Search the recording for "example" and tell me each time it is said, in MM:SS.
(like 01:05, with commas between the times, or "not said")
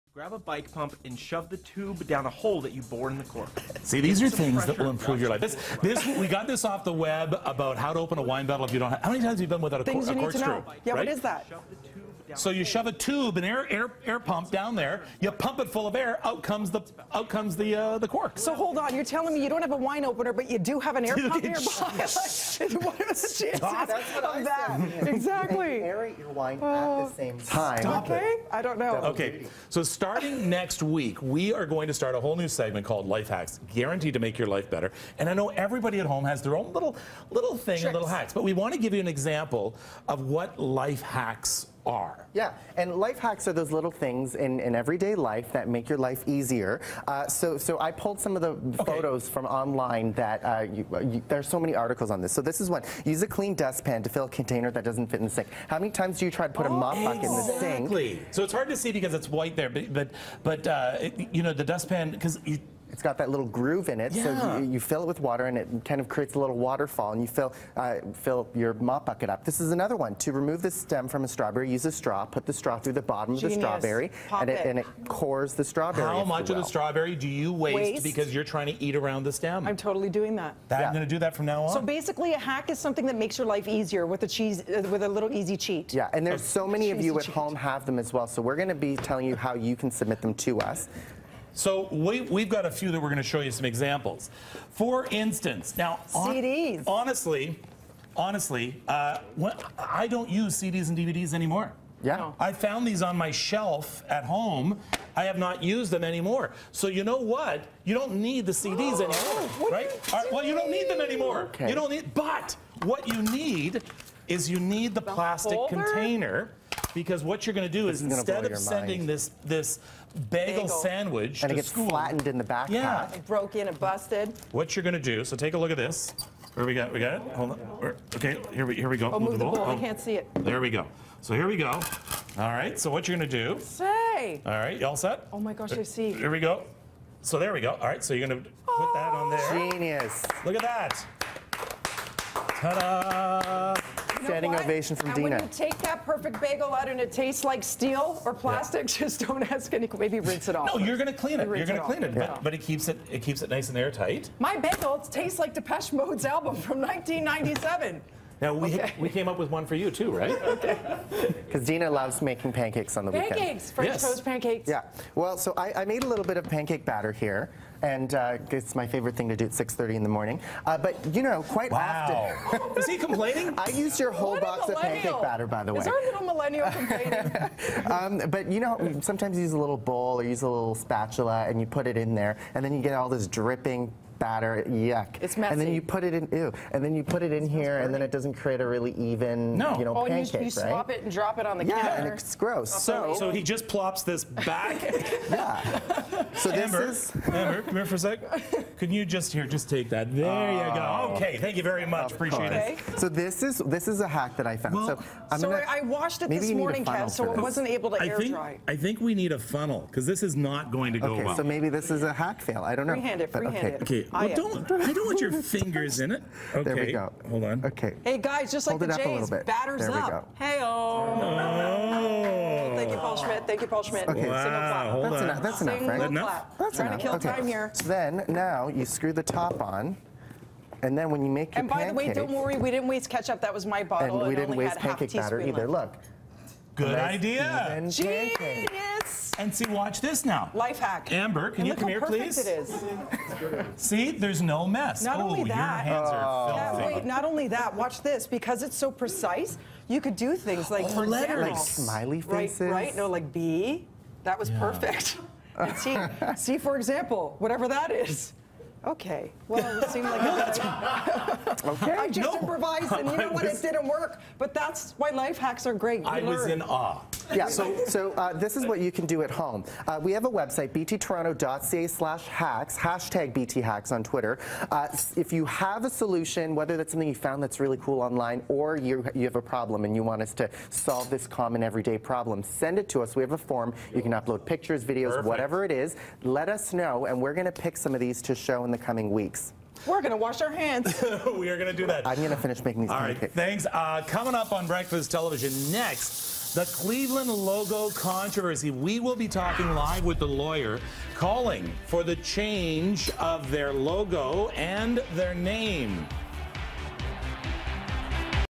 00:39, 01:33, 04:16.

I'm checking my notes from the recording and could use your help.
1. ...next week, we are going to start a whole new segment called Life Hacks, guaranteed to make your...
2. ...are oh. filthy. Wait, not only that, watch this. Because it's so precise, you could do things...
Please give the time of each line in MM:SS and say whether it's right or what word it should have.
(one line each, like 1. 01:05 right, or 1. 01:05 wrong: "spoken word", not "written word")
1. 00:30 right
2. 04:06 right.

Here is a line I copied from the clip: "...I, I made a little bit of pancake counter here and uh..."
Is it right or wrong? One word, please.
wrong.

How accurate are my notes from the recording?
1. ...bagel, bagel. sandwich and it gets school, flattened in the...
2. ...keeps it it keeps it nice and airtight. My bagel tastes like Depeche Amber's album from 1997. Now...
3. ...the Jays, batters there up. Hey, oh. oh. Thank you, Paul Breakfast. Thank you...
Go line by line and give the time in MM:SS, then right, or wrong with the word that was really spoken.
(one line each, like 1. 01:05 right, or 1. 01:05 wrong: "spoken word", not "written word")
1. 02:00 right
2. 02:32 wrong: "Mode", not "Amber"
3. 03:38 wrong: "Schmidt", not "Breakfast".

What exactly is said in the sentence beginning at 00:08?
Have, how many times have you been without a, cork?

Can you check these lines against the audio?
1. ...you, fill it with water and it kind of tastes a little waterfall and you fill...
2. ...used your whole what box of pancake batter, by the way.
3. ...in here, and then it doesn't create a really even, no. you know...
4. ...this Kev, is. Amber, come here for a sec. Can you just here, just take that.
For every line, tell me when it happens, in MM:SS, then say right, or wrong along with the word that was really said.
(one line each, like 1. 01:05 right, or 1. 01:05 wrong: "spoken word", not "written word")
1. 01:04 wrong: "creates", not "tastes"
2. 02:53 right
3. 03:07 right
4. 03:16 wrong: "Amber", not "Kev".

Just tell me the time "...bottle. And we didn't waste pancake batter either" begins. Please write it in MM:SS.
03:53.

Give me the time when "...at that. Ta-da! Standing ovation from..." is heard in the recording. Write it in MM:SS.
02:20.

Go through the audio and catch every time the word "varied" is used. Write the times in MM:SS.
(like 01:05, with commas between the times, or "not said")
not said.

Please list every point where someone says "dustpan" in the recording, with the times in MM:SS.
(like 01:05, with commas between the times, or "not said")
00:53, 01:01.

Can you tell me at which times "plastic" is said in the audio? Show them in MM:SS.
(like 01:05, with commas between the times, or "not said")
01:55, 02:28.